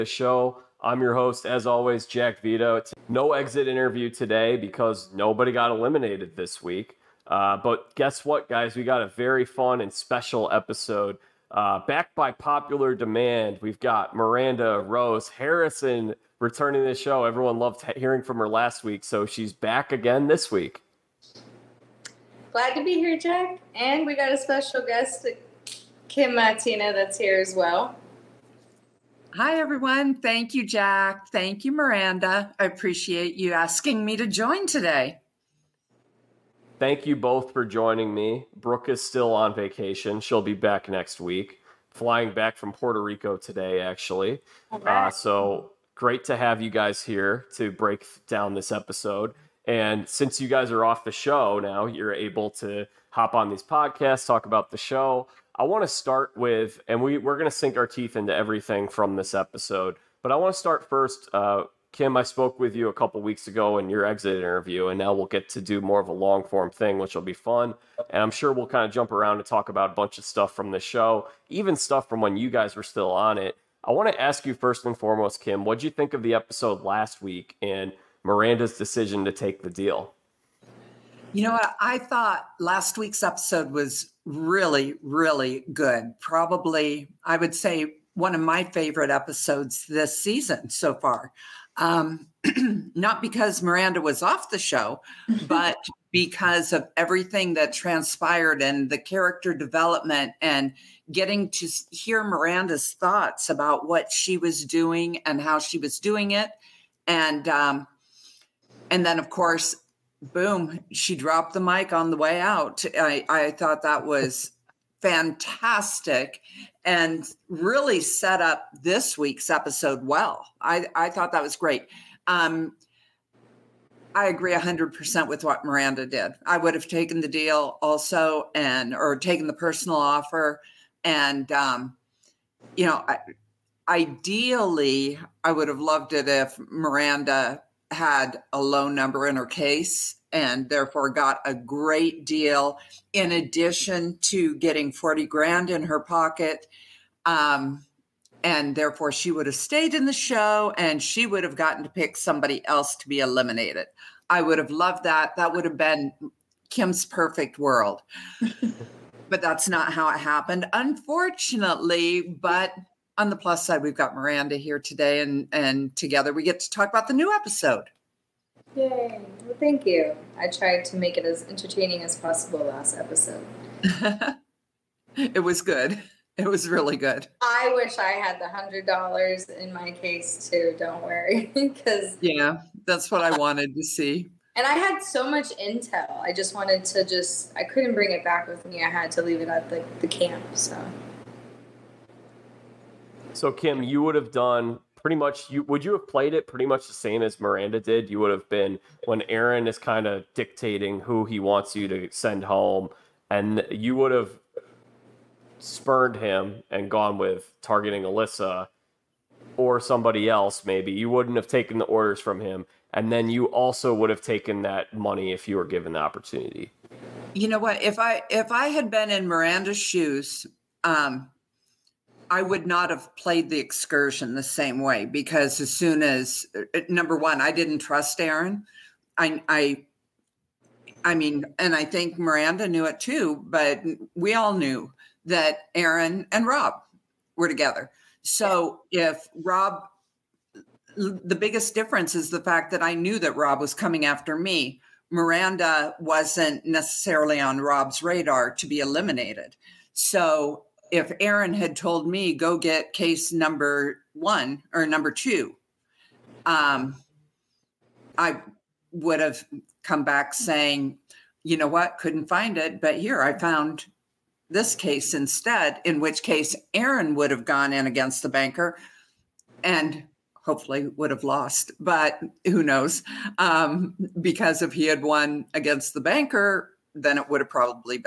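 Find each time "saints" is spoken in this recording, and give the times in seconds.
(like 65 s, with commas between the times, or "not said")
not said.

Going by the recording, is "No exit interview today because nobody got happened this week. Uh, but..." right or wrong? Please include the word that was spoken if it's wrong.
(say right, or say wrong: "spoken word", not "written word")
wrong: "eliminated", not "happened".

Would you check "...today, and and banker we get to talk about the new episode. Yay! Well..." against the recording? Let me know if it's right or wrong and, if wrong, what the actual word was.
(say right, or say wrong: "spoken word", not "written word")
wrong: "together", not "banker".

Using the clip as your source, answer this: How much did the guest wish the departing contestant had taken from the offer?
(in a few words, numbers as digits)
$40,000.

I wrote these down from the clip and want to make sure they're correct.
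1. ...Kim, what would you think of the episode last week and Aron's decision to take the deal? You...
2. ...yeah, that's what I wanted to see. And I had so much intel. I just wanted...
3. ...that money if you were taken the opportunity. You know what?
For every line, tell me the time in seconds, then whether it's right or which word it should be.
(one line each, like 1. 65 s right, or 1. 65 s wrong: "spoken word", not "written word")
1. 75 s wrong: "Miranda", not "Aron"
2. 182 s right
3. 214 s wrong: "given", not "taken".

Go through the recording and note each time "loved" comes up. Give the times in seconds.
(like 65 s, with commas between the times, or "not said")
17 s, 135 s, 154 s.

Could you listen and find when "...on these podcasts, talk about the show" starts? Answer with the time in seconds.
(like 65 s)
53 s.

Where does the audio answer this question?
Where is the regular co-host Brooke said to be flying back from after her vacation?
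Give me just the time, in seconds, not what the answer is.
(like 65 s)
42 s.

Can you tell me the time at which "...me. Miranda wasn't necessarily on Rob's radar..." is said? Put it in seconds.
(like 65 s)
244 s.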